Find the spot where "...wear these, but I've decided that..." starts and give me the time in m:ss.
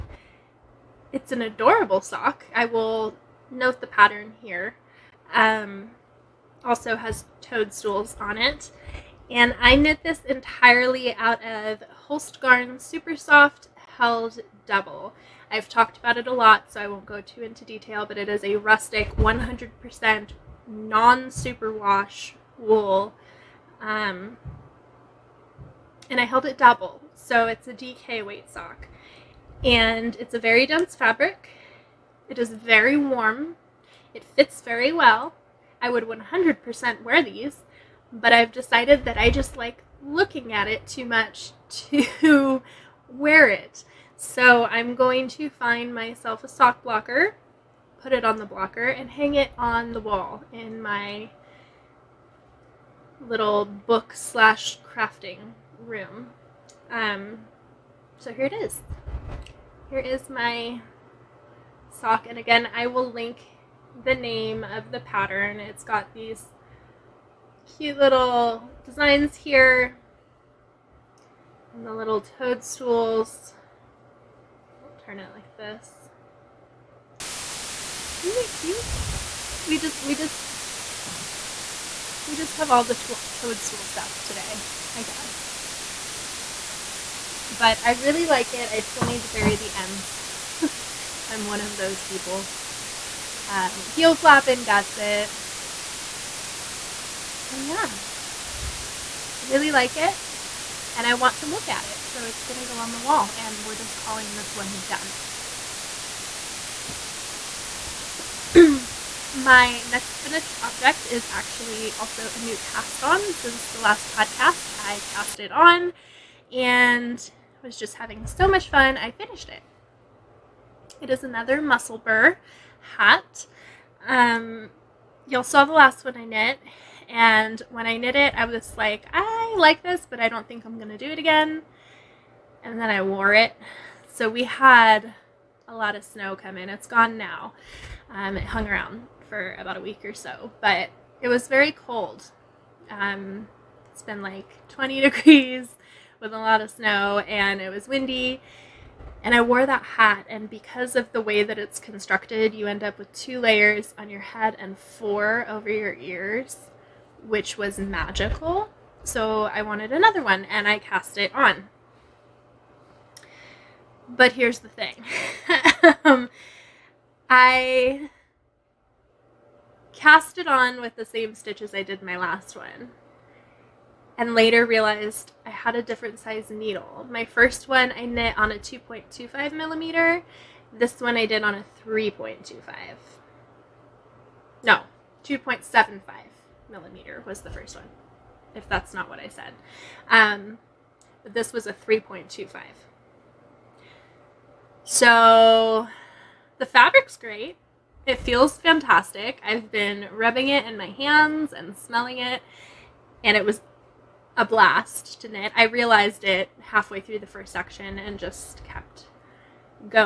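0:37.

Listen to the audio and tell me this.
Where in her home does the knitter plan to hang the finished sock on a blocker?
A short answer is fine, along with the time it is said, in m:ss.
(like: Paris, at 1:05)
book slash crafting room, at 0:53.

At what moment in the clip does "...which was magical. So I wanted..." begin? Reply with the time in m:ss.
2:37.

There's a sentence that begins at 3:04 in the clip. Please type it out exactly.
No, 2.75 millimeter was the first one, if that's not what I said.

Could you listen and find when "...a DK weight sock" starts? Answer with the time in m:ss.
0:27.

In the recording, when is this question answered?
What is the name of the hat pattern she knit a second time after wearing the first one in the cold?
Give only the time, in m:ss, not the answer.
2:01.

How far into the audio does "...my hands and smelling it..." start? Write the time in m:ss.
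3:20.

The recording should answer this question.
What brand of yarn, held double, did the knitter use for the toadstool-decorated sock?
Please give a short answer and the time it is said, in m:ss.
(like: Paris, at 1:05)
Holstgarn Super Soft, at 0:12.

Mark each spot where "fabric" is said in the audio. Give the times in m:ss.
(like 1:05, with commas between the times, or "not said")
0:30, 3:16.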